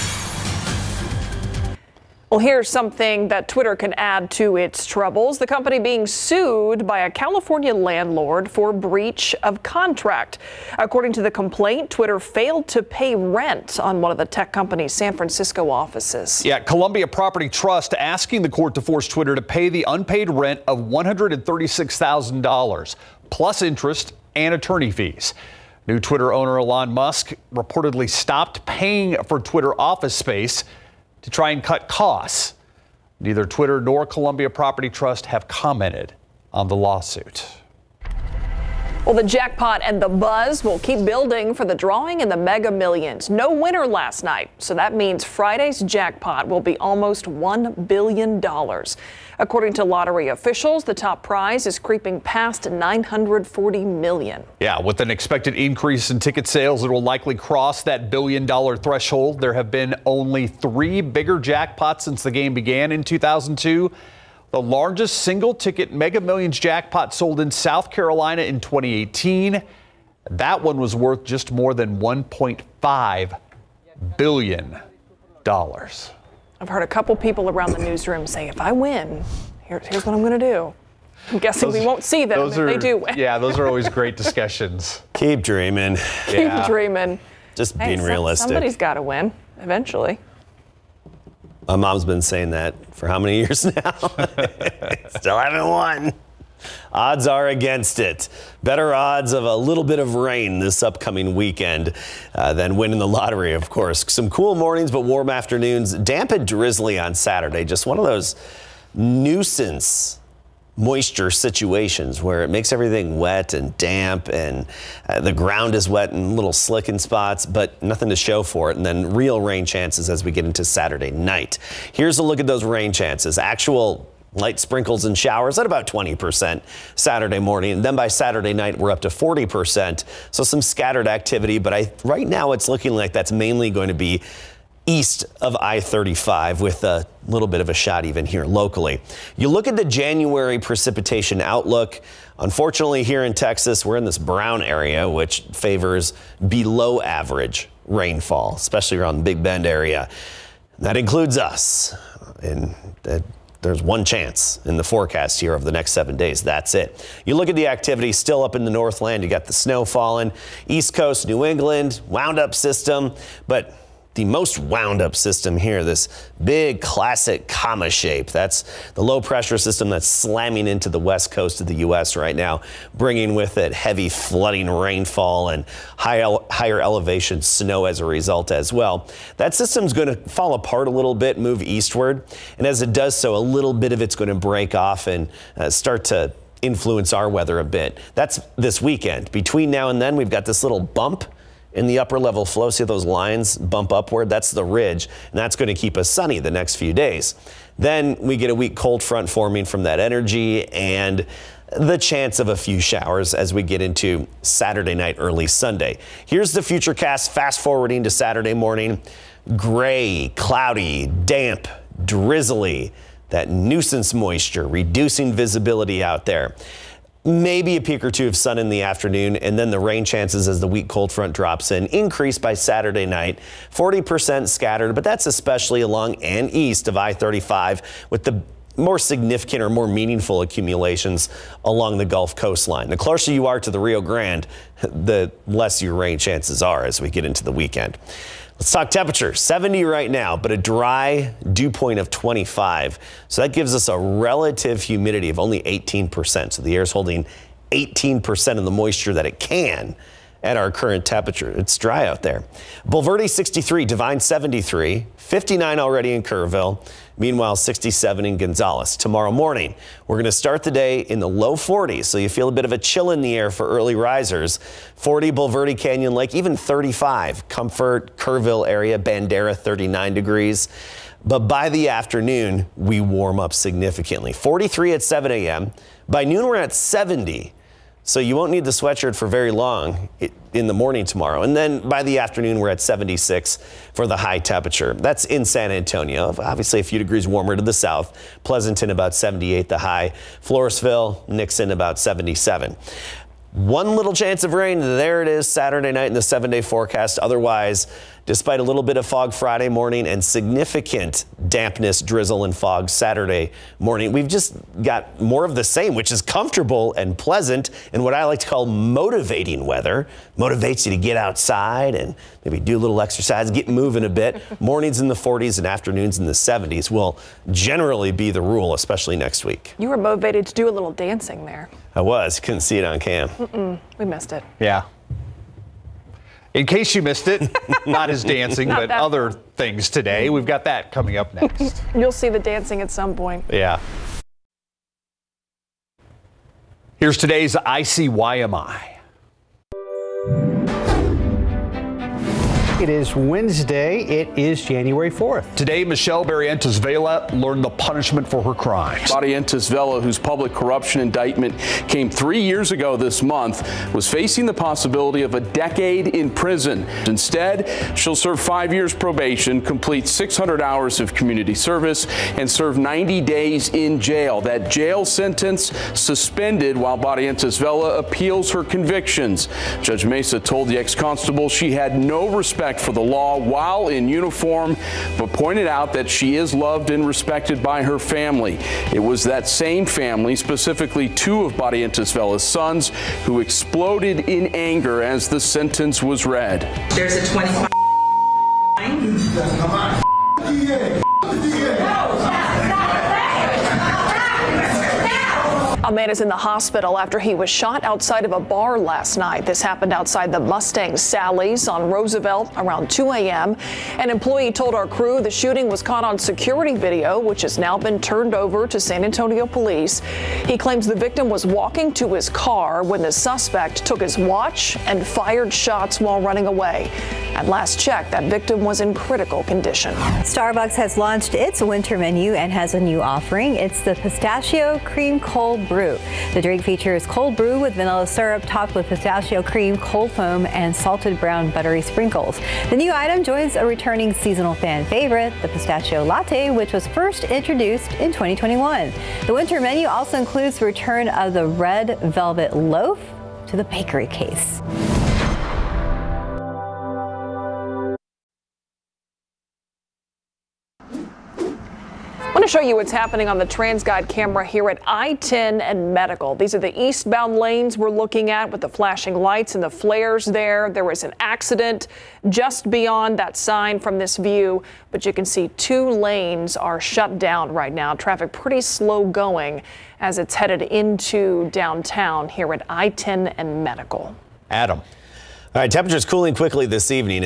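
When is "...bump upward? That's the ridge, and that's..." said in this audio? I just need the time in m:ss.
3:13.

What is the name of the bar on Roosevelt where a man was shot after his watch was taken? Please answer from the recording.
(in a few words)
Mustang Sally's.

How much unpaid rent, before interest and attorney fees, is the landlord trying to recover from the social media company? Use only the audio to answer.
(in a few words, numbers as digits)
$136,000.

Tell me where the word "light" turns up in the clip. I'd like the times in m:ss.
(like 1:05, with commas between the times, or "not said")
2:04, 7:39.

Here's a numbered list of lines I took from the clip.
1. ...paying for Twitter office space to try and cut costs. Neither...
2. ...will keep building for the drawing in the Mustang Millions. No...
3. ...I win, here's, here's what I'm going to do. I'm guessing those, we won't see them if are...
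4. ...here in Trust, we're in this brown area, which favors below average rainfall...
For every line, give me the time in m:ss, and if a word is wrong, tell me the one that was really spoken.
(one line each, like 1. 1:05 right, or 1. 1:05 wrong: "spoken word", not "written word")
1. 0:28 right
2. 0:40 wrong: "Mega", not "Mustang"
3. 1:18 right
4. 2:23 wrong: "Texas", not "Trust".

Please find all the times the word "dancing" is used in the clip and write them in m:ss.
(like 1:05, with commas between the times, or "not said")
5:20, 5:28, 5:32.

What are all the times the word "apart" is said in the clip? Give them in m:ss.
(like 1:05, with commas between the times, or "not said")
3:00.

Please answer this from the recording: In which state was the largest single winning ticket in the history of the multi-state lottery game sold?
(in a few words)
South Carolina.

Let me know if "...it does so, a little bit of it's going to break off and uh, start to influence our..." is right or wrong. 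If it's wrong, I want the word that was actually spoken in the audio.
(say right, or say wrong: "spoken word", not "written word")
right.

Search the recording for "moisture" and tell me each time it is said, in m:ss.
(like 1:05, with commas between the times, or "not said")
1:50, 3:34, 4:08.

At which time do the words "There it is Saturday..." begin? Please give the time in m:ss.
4:54.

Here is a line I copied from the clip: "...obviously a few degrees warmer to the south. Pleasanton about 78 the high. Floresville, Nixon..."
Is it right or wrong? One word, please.
right.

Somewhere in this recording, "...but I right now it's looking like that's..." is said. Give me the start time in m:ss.
2:11.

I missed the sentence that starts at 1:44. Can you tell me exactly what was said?
Some cool mornings, but warm afternoons.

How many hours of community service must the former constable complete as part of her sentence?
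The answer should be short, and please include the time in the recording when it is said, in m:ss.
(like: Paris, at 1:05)
600, at 6:00.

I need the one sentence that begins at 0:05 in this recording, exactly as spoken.
The company being sued by a California landlord for breach of contract.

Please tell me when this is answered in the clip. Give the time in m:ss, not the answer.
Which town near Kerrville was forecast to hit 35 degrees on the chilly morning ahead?
4:27.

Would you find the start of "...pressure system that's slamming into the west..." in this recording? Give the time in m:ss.
2:49.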